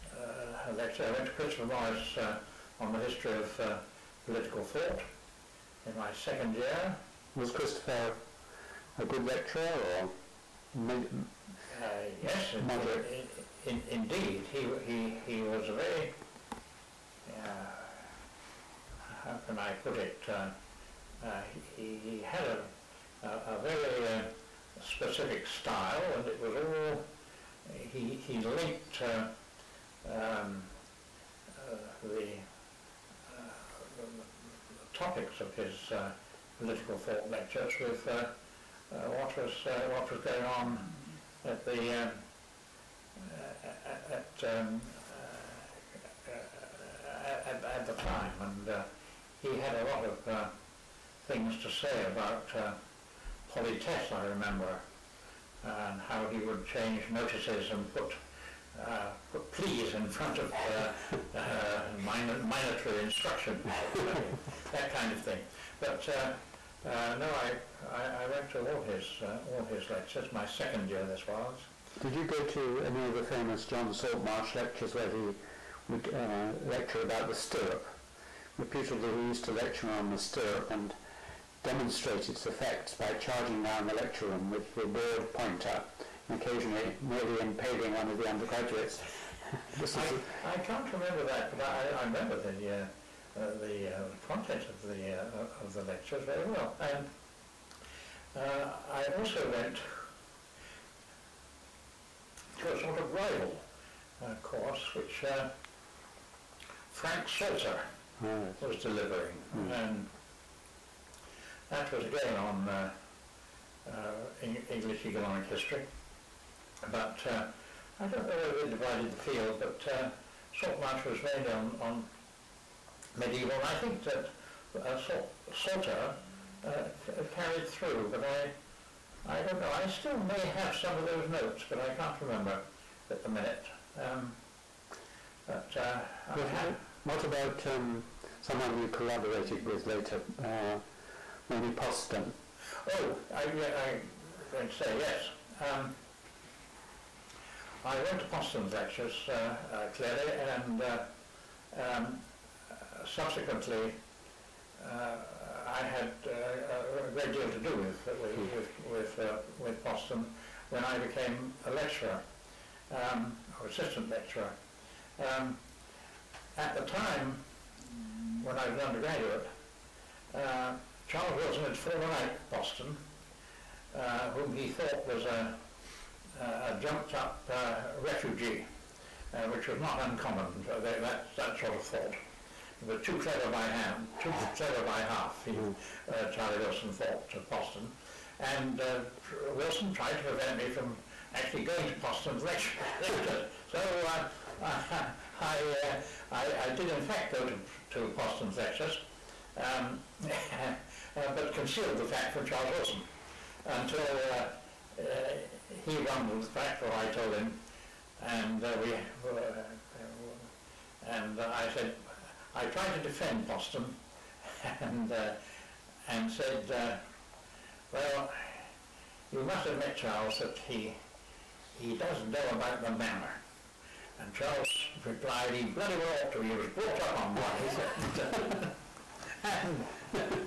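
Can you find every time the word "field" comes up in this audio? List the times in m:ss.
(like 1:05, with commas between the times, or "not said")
1:59.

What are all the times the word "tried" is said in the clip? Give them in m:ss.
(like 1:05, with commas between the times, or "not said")
3:09, 3:32.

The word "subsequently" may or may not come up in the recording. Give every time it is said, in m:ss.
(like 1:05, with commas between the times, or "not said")
2:33.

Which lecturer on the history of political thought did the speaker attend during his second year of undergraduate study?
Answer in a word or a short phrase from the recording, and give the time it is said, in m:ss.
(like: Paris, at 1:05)
Christopher Morris, at 0:01.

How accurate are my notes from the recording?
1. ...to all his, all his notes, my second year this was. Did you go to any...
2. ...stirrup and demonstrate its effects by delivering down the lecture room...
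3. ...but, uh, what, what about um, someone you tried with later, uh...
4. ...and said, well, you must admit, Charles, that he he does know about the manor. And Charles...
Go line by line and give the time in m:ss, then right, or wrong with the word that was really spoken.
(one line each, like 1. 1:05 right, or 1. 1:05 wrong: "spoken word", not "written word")
1. 1:08 wrong: "lectures", not "notes"
2. 1:20 wrong: "charging", not "delivering"
3. 2:15 wrong: "collaborated", not "tried"
4. 3:36 right.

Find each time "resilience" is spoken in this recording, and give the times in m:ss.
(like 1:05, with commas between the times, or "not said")
not said.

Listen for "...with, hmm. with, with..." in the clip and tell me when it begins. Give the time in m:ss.
2:38.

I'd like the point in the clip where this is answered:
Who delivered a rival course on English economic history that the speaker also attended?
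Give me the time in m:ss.
1:46.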